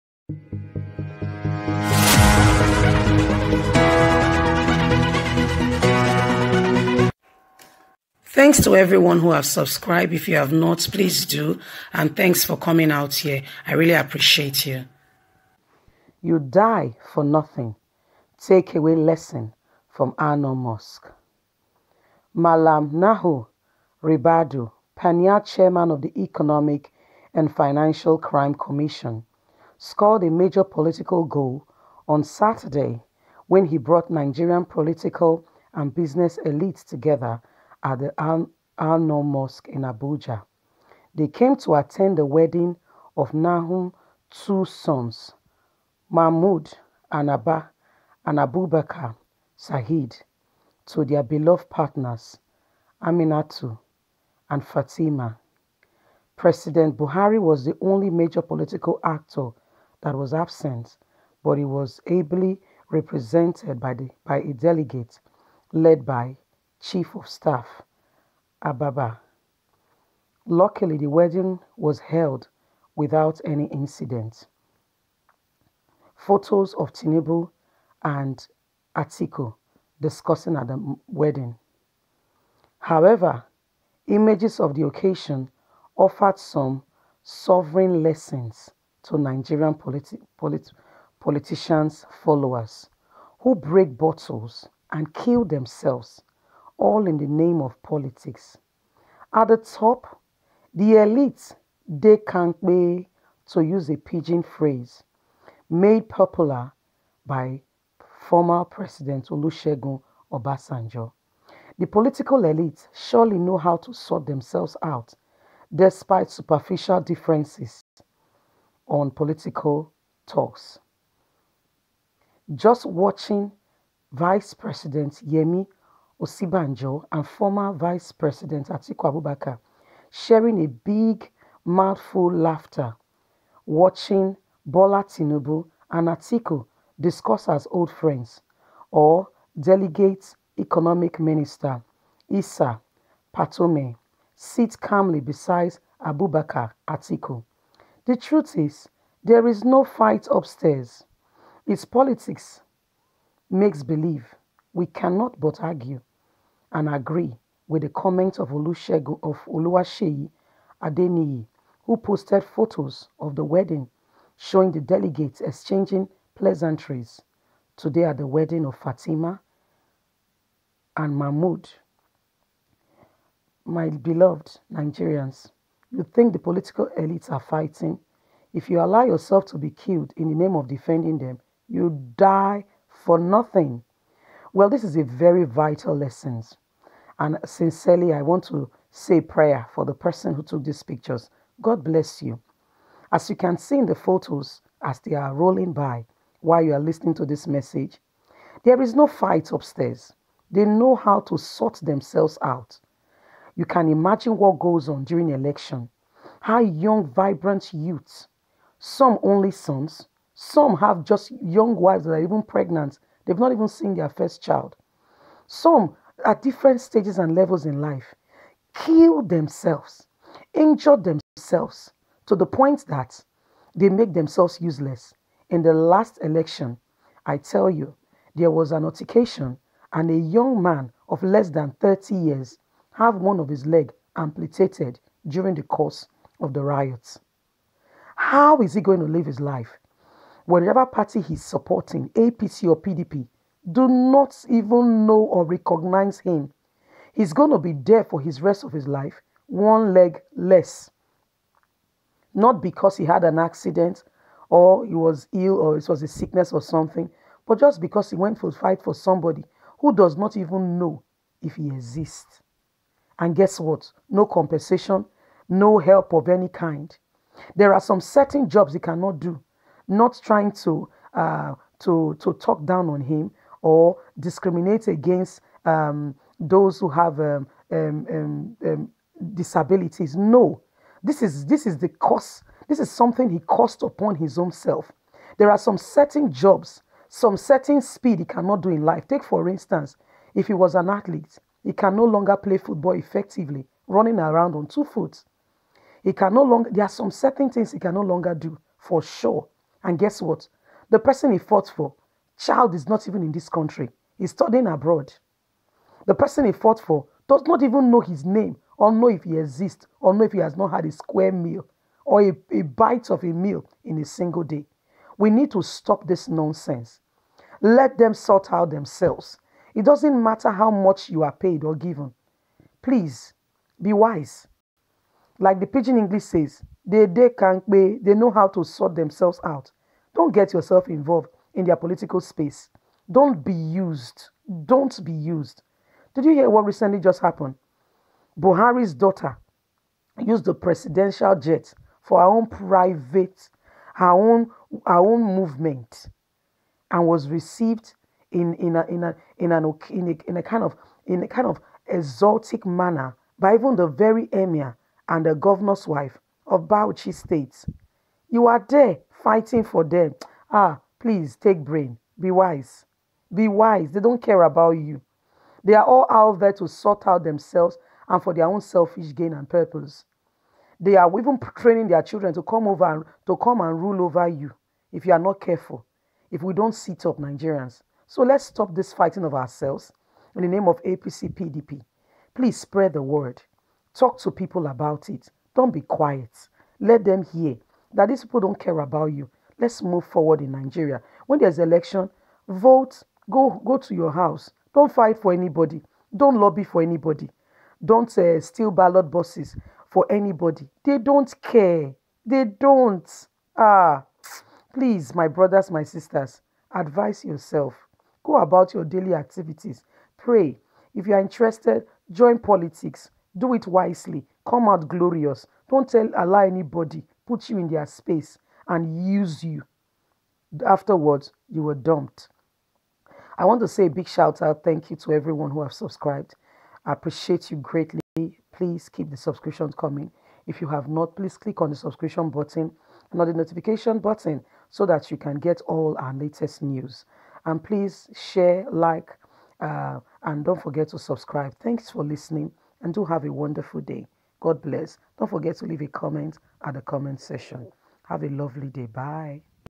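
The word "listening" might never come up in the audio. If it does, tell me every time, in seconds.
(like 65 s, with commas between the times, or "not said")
196 s, 442 s.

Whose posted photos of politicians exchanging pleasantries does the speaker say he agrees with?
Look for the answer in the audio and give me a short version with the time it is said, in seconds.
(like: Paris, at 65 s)
Oluwaseyi Adeniyi, at 159 s.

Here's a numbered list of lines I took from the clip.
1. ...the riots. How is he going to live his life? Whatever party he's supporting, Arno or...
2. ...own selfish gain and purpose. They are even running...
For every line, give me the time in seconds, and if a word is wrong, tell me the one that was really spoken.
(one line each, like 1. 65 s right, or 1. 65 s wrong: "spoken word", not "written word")
1. 236 s wrong: "APC", not "Arno"
2. 368 s wrong: "training", not "running".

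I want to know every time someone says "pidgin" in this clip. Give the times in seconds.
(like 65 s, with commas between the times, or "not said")
103 s, 325 s.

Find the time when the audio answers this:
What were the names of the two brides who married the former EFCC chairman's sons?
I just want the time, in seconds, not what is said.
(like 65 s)
53 s.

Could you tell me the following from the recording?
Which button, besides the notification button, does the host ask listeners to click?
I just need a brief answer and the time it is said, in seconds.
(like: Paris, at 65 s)
subscription button, at 431 s.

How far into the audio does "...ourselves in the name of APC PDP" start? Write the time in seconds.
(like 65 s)
379 s.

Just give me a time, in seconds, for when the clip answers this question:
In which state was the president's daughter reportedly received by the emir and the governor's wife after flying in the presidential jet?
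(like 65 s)
356 s.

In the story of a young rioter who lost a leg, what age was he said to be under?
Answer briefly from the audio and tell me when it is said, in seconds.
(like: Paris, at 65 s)
30, at 231 s.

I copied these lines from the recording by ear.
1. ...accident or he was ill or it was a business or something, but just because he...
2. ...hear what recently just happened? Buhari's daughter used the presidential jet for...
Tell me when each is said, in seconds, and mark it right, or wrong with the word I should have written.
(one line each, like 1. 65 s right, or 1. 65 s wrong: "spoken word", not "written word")
1. 253 s wrong: "sickness", not "business"
2. 336 s right.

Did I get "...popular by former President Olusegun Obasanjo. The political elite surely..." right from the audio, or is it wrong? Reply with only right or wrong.
right.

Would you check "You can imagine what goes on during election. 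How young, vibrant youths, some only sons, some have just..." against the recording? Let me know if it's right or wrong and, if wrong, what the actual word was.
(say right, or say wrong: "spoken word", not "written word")
right.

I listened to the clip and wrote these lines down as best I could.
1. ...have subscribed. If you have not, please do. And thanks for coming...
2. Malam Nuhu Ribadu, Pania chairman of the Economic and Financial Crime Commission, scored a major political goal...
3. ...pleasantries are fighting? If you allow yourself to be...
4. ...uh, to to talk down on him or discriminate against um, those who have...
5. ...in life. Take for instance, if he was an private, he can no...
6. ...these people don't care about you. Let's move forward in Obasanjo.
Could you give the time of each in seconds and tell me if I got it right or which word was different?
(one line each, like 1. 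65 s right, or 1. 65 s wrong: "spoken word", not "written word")
1. 9 s right
2. 22 s right
3. 176 s wrong: "elites", not "pleasantries"
4. 271 s right
5. 288 s wrong: "athlete", not "private"
6. 388 s wrong: "Nigeria", not "Obasanjo".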